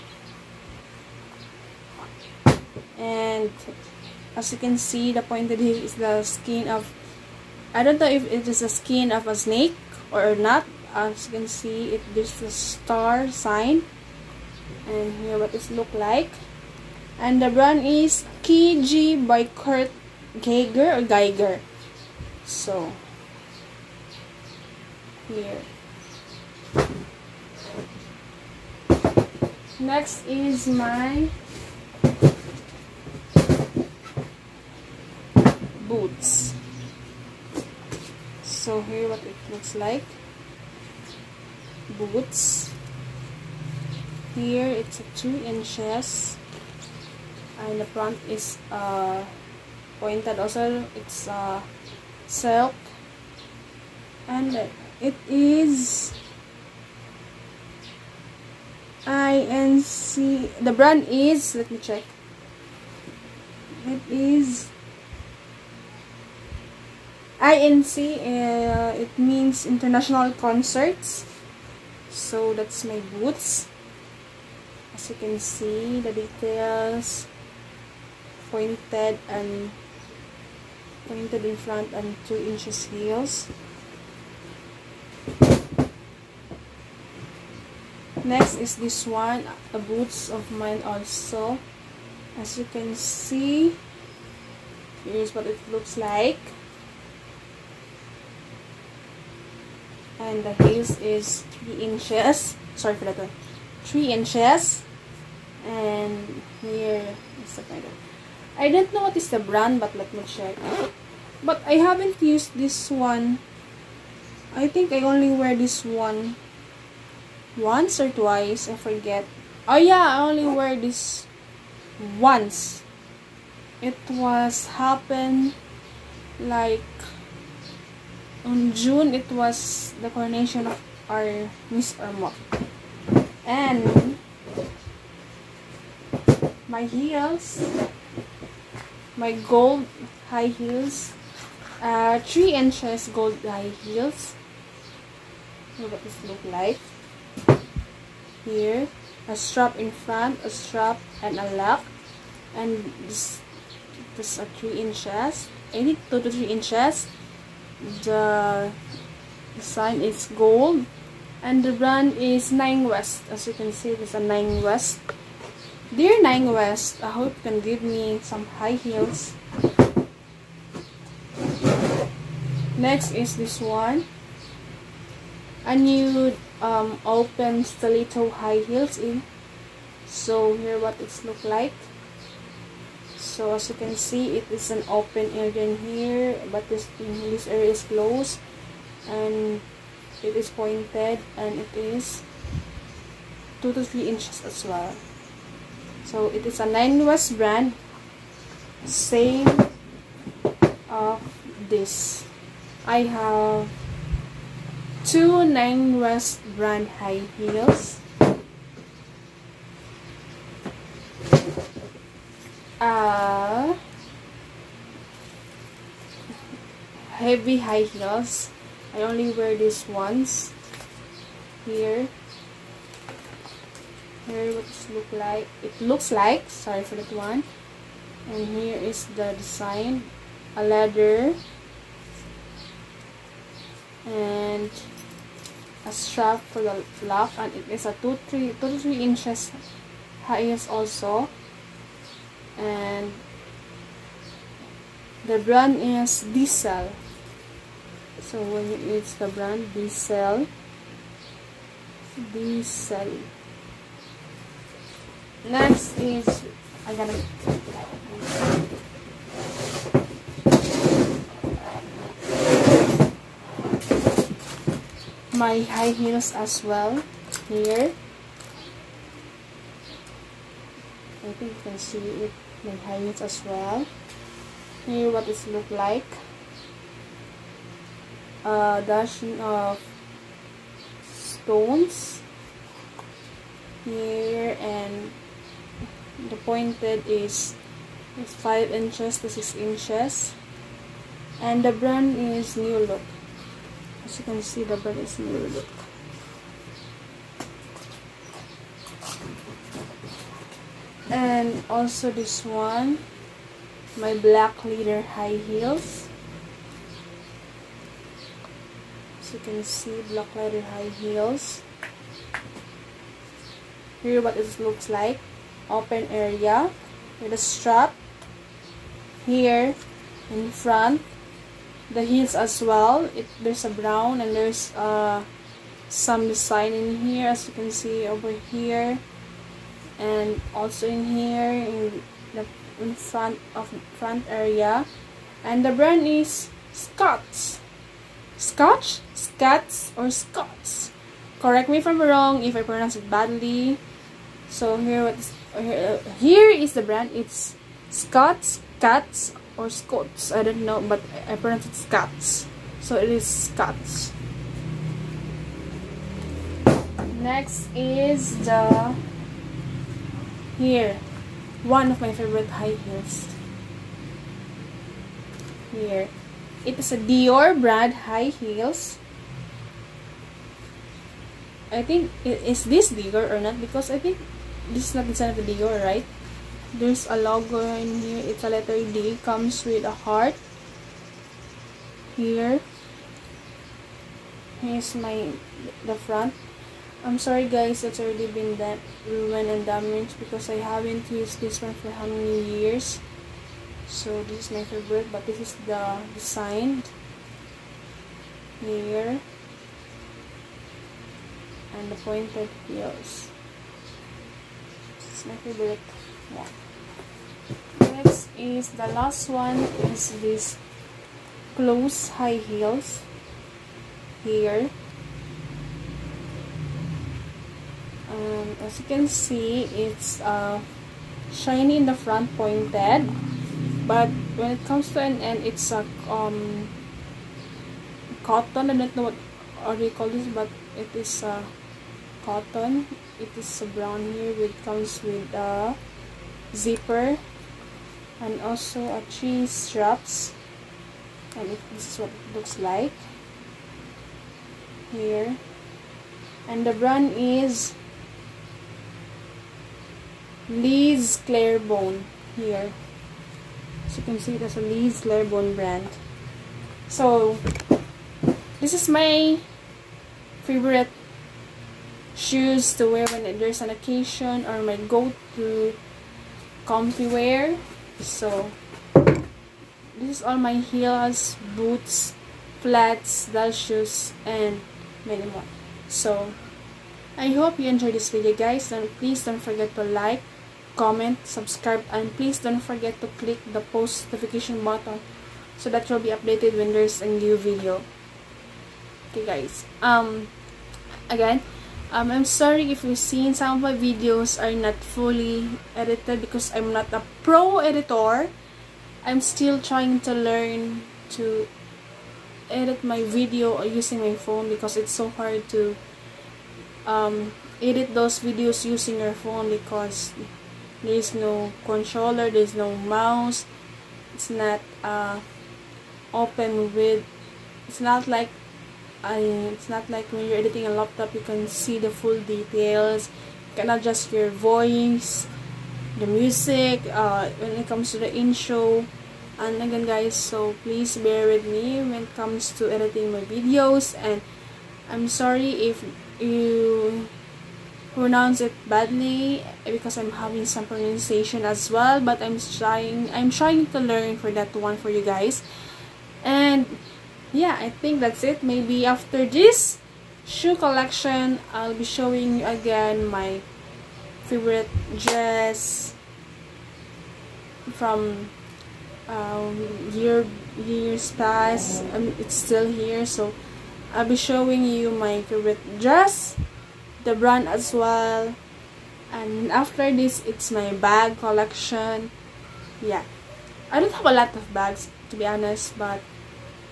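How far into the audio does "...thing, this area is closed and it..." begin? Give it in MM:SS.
03:06.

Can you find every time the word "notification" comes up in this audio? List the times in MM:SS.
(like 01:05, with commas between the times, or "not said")
08:04.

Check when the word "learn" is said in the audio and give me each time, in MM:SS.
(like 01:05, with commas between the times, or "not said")
08:20, 09:03.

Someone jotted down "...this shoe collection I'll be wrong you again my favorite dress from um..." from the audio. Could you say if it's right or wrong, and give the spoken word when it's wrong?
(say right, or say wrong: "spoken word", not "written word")
wrong: "showing", not "wrong".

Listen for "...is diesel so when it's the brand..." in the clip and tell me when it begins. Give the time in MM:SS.
04:05.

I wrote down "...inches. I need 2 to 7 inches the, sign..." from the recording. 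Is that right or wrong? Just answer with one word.
wrong.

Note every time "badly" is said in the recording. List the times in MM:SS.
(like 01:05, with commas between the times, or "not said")
05:43, 08:58.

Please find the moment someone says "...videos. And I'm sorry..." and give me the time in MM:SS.
08:53.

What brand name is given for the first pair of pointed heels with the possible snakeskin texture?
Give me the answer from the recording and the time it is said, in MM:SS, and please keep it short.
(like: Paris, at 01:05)
KG by Kurt Geiger, at 00:18.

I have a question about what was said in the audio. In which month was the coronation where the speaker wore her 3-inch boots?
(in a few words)
June.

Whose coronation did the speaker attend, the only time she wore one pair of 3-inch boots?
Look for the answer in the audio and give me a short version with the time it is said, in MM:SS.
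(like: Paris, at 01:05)
Miss Irma, at 02:11.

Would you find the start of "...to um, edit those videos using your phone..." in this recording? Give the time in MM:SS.
08:25.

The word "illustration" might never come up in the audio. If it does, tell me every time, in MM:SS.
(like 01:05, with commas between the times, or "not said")
not said.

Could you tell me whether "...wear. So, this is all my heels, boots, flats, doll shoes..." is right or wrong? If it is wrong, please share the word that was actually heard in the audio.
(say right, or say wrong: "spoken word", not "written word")
right.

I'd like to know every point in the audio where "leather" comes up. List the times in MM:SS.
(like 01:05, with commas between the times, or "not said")
03:50, 05:04, 05:10.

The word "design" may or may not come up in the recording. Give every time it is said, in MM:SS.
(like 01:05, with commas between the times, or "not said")
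03:49, 05:26, 06:36.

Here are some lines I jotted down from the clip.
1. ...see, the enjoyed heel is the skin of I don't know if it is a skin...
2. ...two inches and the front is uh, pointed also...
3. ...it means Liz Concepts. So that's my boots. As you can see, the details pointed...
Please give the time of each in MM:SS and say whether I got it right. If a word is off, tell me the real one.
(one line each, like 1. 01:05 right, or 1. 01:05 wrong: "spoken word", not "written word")
1. 00:04 wrong: "pointed", not "enjoyed"
2. 00:45 right
3. 01:09 wrong: "International", not "Liz".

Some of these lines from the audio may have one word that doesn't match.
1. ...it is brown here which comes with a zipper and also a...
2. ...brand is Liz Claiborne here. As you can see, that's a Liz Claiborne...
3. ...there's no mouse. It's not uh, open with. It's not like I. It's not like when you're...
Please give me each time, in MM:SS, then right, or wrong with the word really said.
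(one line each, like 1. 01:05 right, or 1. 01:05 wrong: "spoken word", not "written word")
1. 07:13 right
2. 07:26 right
3. 08:32 right.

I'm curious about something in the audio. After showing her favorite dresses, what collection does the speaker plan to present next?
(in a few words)
bag collection.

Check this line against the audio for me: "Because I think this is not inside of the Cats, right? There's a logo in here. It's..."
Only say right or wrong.
wrong.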